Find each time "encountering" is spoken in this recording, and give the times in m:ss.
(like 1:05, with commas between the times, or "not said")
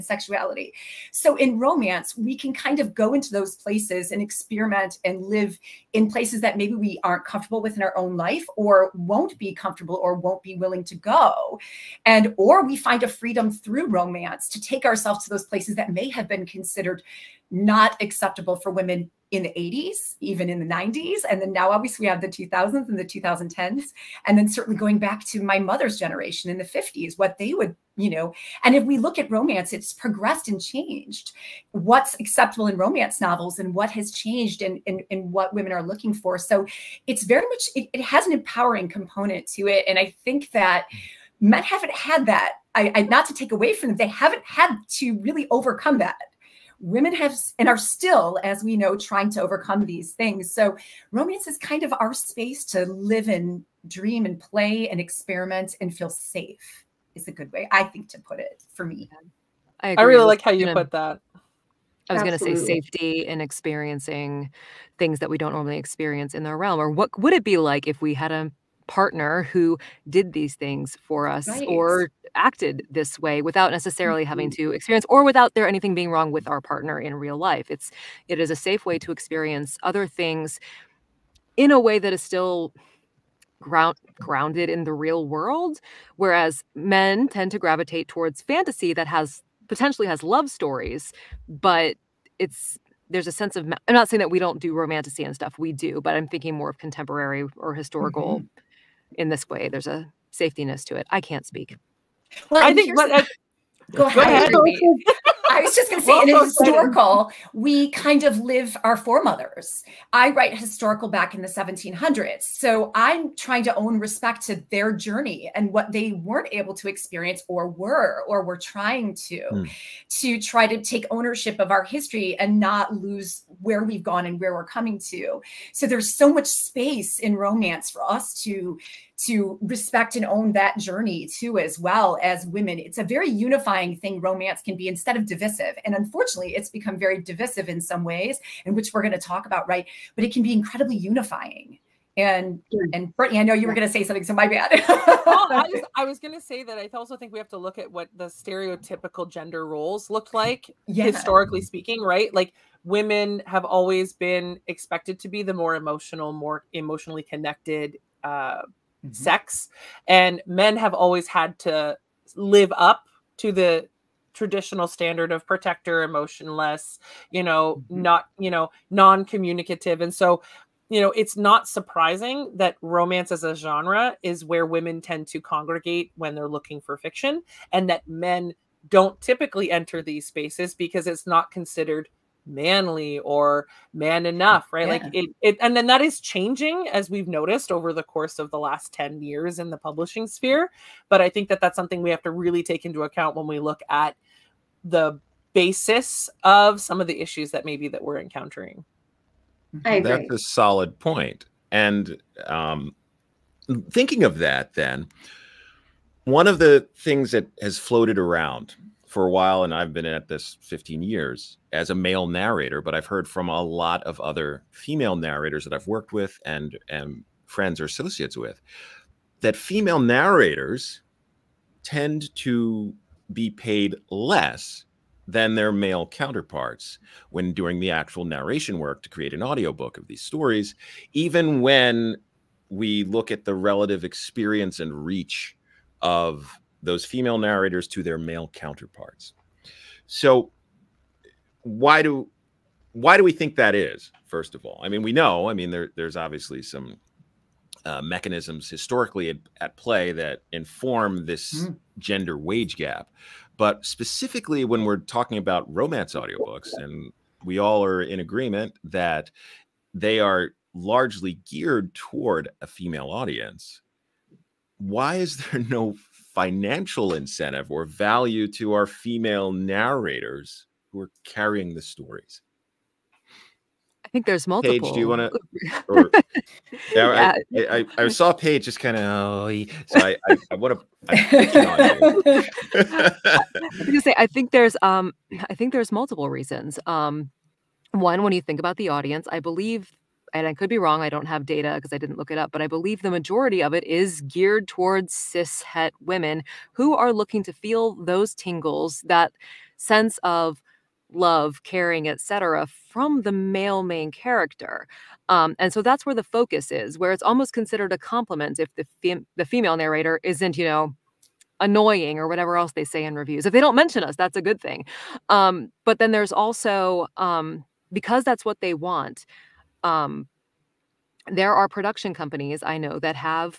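3:18.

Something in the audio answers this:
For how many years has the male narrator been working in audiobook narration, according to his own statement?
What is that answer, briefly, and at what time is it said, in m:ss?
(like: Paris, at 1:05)
15 years, at 3:30.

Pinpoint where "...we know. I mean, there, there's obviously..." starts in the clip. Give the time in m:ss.
4:05.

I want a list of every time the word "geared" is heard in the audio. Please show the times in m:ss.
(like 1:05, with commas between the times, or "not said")
4:21, 4:54.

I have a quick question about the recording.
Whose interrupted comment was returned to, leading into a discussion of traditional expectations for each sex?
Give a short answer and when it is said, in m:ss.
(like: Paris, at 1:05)
Brittney, at 2:23.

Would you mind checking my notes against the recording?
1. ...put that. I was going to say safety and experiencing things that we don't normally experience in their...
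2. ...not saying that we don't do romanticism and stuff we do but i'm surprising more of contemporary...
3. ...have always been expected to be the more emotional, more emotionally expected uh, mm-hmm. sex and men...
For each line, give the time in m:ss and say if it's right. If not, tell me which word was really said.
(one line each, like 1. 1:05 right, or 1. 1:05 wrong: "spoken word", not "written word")
1. 1:00 right
2. 1:33 wrong: "thinking", not "surprising"
3. 2:33 wrong: "connected", not "expected".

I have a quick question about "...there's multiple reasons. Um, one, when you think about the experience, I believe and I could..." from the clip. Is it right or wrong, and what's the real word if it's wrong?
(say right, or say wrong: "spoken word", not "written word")
wrong: "audience", not "experience".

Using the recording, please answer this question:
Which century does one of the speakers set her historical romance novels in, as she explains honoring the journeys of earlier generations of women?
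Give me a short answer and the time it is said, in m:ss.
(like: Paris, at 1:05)
1700s, at 1:51.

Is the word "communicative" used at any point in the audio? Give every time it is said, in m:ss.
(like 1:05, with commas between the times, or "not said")
2:48.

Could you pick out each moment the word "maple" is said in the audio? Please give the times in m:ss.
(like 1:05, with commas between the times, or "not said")
not said.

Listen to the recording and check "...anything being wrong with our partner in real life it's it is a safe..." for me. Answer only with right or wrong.
right.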